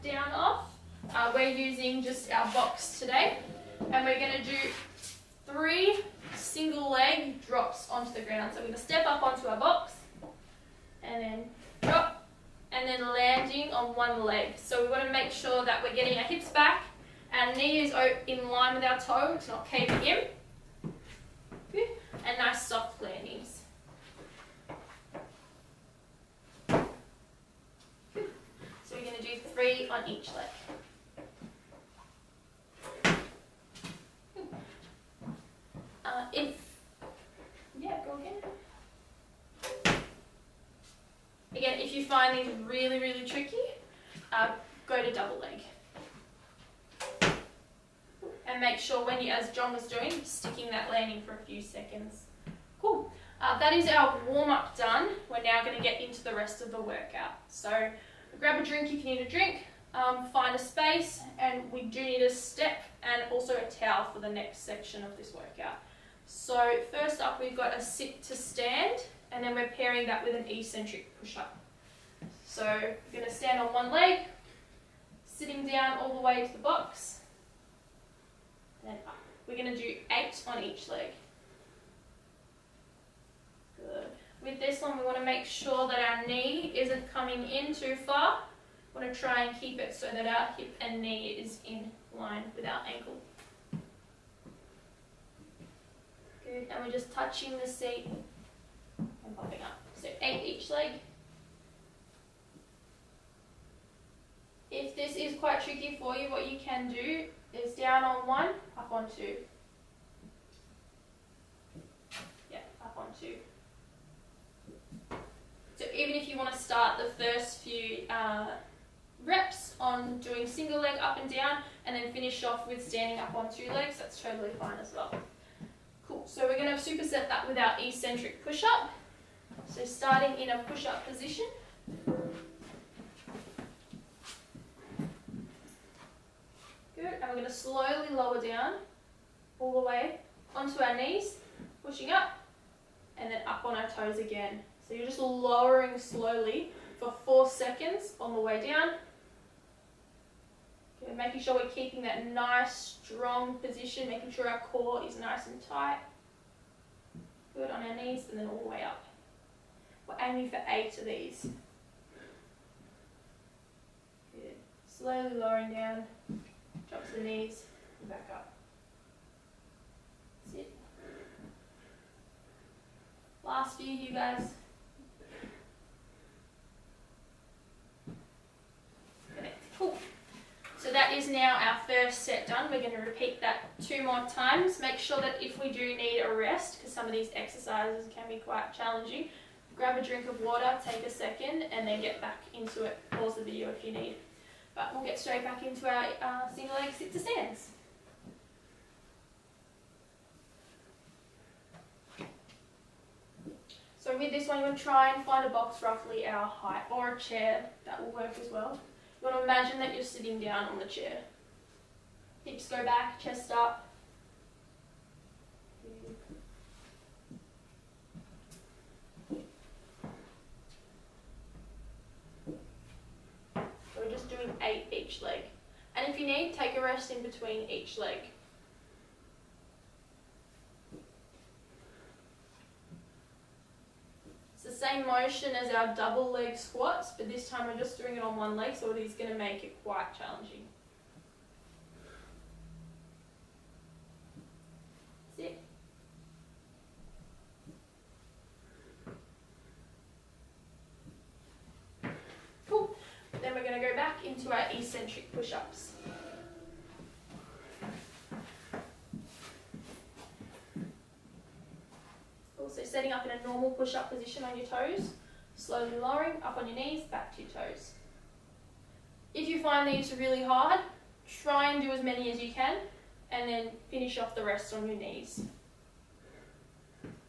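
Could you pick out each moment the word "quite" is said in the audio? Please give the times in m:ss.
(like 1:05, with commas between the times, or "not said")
1:45, 3:08, 3:59.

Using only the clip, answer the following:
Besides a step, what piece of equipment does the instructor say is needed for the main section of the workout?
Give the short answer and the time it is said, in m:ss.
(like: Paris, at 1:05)
A towel, at 1:03.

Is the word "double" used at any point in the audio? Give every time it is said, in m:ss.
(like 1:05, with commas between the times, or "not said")
0:45, 3:55.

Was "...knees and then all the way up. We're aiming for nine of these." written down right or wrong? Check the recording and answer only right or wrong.
wrong.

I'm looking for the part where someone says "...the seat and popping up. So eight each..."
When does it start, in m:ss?
1:37.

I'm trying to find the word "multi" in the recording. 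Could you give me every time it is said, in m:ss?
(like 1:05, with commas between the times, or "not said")
not said.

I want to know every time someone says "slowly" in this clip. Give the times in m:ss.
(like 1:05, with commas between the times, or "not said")
2:17, 2:25, 2:44, 4:25.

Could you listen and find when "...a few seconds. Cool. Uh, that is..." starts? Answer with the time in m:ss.
0:51.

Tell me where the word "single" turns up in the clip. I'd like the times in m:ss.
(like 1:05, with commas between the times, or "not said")
2:00, 3:16.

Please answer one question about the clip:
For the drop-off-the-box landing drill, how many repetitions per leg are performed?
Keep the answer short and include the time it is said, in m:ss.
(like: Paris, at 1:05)
3, at 0:29.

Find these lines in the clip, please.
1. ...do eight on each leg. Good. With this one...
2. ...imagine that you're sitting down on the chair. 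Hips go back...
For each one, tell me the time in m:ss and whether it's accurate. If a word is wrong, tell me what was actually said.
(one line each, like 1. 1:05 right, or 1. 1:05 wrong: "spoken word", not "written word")
1. 1:19 right
2. 3:29 right.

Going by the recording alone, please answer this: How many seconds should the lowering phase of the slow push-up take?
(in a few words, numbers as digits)
4.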